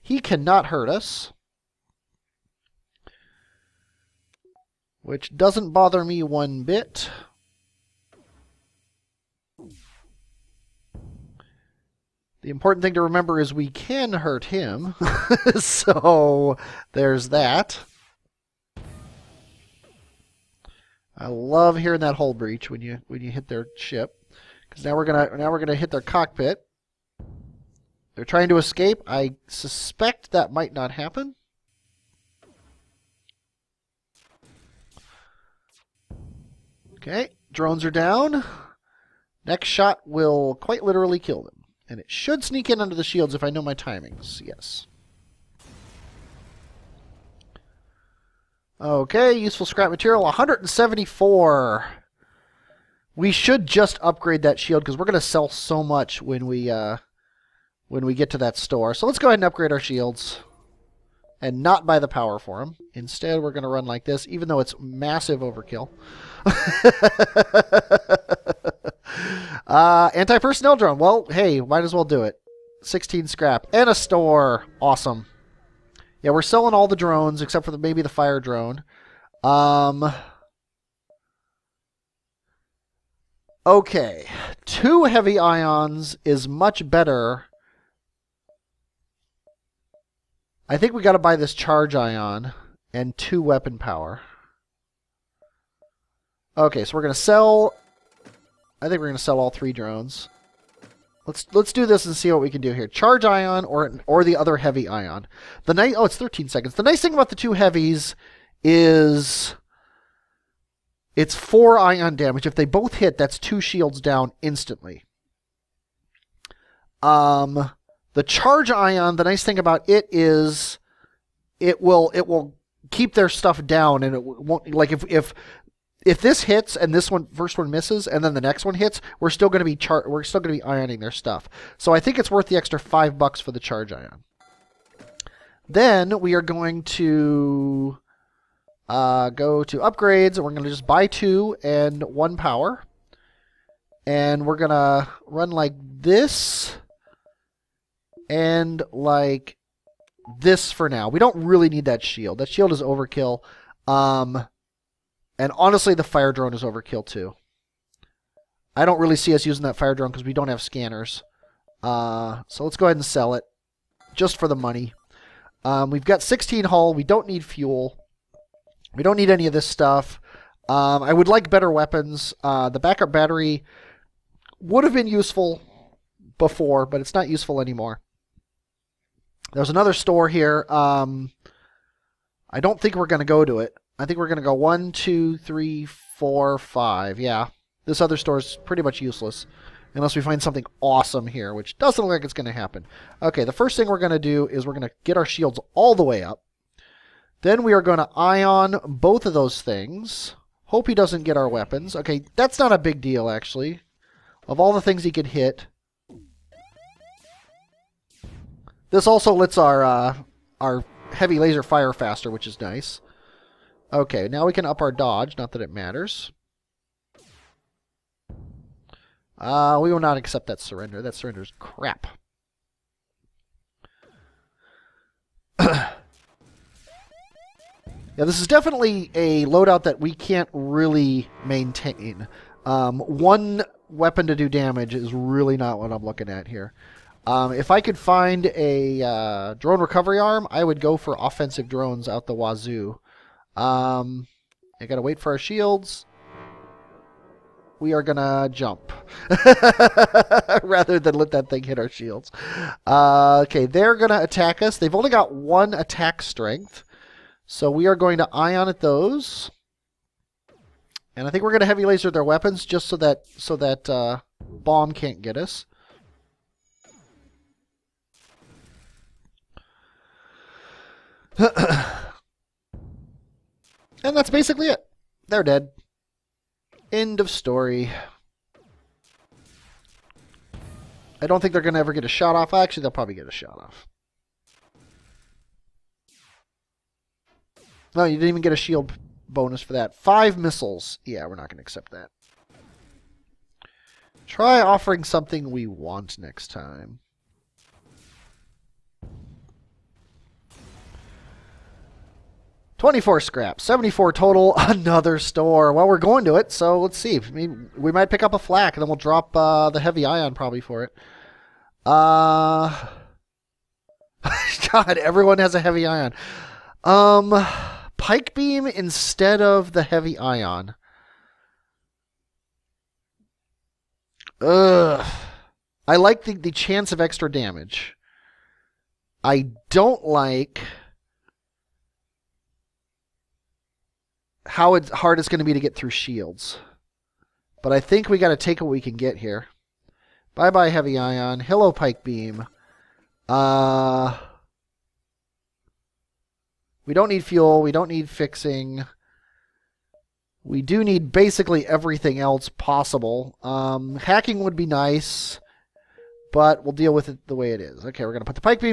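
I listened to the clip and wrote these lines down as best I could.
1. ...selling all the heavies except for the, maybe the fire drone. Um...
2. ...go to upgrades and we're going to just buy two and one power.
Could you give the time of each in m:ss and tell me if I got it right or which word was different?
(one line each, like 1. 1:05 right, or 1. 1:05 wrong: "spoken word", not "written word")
1. 1:16 wrong: "drones", not "heavies"
2. 2:19 right.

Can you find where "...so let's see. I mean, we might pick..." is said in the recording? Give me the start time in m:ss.
5:06.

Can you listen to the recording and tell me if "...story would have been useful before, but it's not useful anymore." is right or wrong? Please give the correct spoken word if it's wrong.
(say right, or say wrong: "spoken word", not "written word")
wrong: "battery", not "story".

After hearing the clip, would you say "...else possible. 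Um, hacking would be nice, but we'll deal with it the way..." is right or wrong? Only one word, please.
right.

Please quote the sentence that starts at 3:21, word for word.
Okay, that's not a big deal, actually.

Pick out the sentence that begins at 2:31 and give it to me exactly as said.
We don't really need that shield.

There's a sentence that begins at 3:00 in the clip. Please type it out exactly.
Um, I don't think we're going to go to it.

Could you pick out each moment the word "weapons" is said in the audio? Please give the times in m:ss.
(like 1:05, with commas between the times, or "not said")
1:33, 2:51, 3:21, 3:53, 4:22.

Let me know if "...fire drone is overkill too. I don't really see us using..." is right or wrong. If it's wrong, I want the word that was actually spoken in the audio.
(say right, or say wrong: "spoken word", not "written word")
right.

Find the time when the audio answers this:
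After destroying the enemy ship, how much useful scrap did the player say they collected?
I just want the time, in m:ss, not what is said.
0:50.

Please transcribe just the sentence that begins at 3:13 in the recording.
Okay, the first thing we're going to do is we're going to get our shields all the way up.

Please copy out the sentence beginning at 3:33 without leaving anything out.
Okay, now we can up our dodge.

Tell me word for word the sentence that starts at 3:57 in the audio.
Um, if I could find a uh, drone recovery arm, I would go for offensive drones out the wazoo.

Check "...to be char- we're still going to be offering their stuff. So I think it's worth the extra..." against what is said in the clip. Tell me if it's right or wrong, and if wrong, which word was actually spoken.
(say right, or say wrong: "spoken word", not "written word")
wrong: "ioning", not "offering".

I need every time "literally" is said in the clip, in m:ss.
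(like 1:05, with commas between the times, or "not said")
0:40.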